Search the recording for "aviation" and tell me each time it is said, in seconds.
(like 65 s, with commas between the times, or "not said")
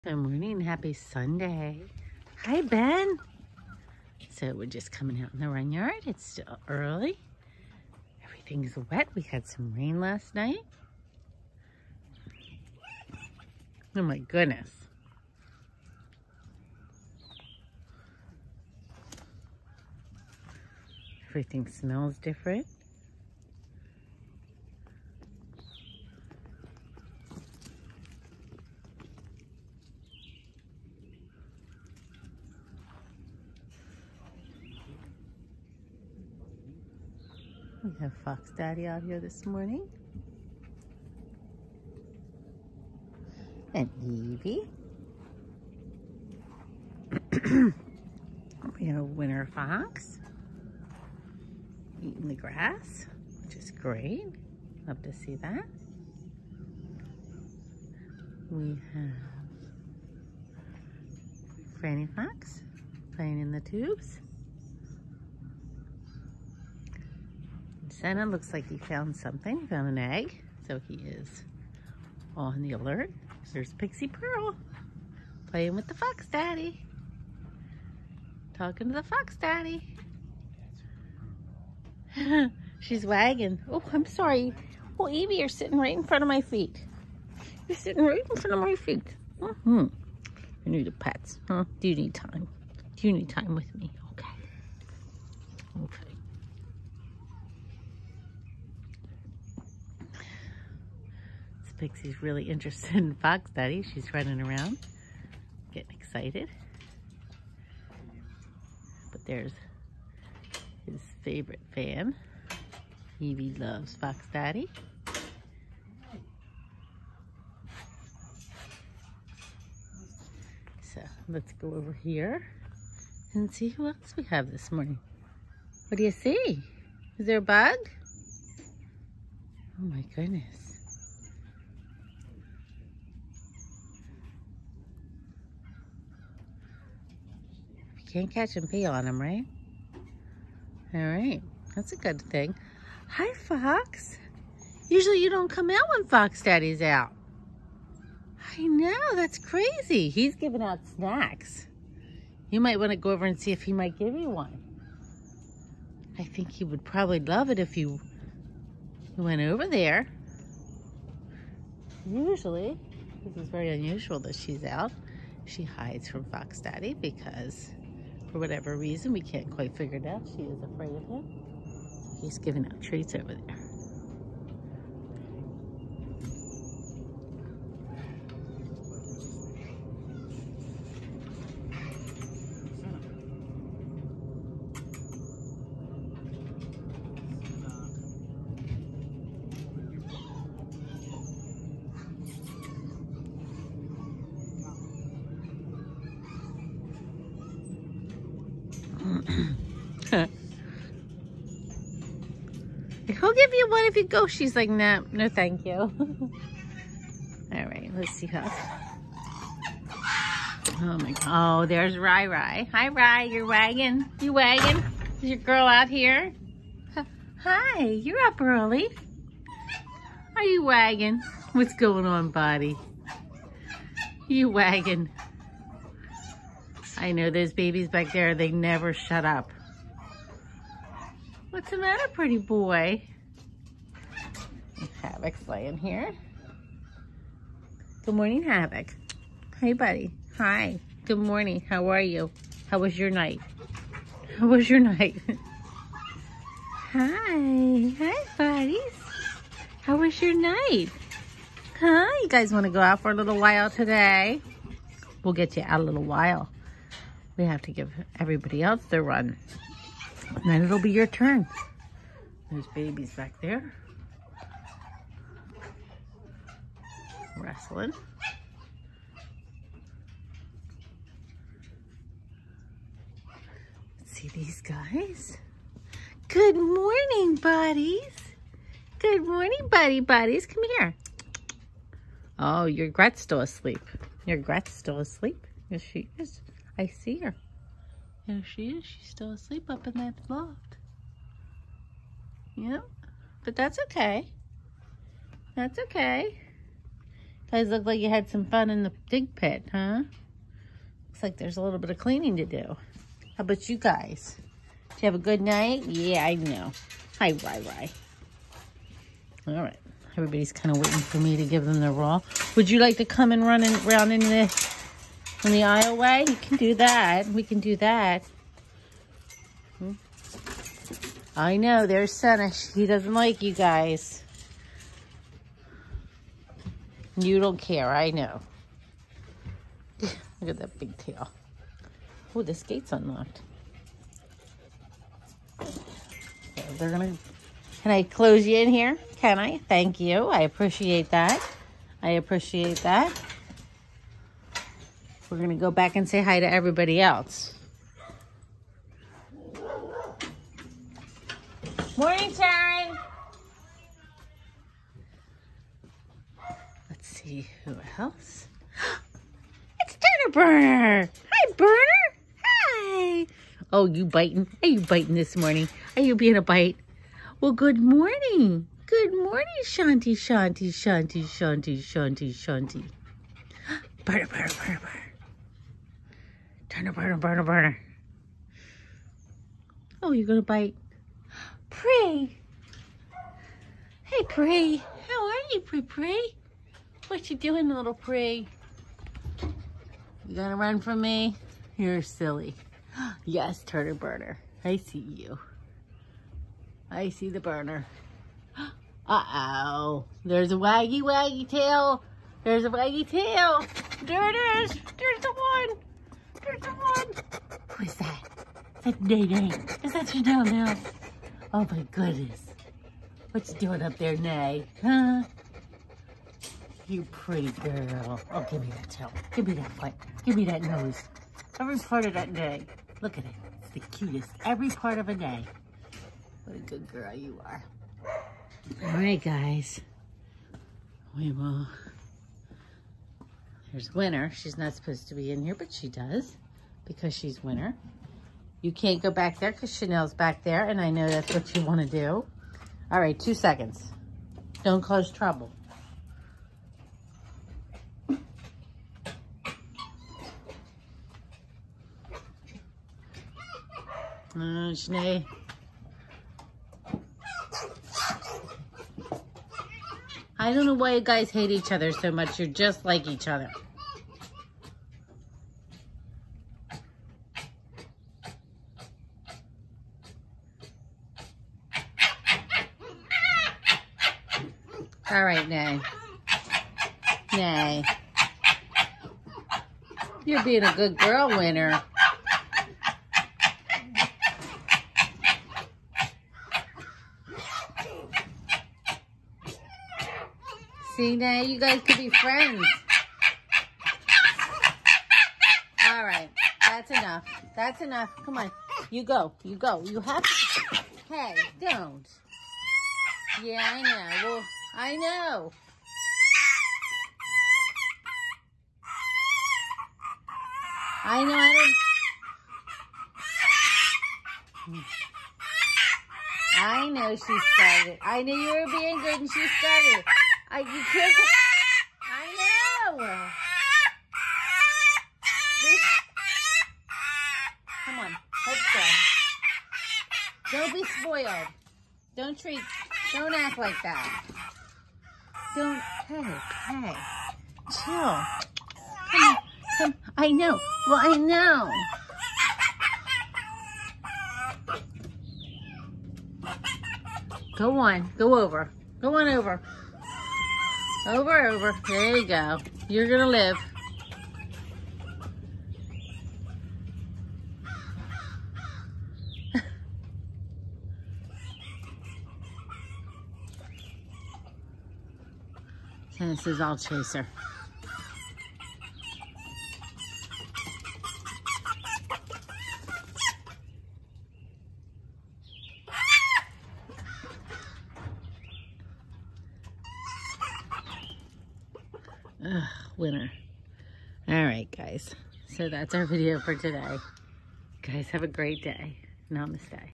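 not said.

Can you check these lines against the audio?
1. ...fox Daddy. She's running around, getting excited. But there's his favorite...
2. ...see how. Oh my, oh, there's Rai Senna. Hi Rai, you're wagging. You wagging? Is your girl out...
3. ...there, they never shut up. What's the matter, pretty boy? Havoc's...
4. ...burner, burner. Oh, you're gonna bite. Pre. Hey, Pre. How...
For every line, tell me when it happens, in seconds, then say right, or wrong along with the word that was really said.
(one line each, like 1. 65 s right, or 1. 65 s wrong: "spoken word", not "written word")
1. 103 s right
2. 208 s wrong: "Rai", not "Senna"
3. 228 s right
4. 377 s right.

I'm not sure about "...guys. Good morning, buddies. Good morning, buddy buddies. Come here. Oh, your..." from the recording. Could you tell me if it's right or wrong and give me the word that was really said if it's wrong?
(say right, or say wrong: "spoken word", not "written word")
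right.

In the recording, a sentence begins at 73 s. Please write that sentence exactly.
There's Pixie Pearl playing with the fox daddy.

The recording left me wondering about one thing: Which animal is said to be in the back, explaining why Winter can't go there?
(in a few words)
Chanel.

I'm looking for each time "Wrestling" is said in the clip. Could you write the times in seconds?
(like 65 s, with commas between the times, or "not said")
267 s.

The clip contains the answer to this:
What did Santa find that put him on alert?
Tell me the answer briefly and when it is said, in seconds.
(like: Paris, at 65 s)
An egg, at 69 s.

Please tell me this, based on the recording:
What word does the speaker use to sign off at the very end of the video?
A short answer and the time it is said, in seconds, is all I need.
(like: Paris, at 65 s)
Namaste, at 589 s.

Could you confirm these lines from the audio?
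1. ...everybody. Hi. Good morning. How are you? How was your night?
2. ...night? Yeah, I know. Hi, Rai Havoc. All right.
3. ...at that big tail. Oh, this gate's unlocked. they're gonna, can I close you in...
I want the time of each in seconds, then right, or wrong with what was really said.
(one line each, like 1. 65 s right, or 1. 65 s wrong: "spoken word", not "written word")
1. 239 s wrong: "buddy", not "everybody"
2. 305 s wrong: "Rai", not "Havoc"
3. 330 s right.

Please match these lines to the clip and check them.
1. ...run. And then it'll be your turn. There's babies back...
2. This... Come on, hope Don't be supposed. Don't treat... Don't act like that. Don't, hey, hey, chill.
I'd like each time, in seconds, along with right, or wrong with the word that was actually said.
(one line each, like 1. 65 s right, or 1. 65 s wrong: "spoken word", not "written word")
1. 259 s right
2. 525 s wrong: "spoiled", not "supposed".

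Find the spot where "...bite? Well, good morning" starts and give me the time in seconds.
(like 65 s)
366 s.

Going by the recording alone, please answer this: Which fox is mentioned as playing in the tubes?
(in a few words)
Franny Fox.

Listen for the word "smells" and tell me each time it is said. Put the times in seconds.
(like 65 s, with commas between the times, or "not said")
21 s.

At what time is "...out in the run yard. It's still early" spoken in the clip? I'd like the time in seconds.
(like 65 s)
5 s.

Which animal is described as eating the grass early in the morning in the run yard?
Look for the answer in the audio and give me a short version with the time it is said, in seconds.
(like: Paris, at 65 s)
Winter Fox, at 49 s.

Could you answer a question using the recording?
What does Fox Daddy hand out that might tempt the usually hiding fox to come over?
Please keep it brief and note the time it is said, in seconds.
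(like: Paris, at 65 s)
Snacks, at 150 s.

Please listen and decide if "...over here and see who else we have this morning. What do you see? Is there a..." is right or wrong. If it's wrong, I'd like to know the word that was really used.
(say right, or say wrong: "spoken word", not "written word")
right.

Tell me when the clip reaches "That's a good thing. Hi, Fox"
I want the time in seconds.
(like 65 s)
141 s.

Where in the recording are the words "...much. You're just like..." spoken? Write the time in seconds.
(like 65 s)
462 s.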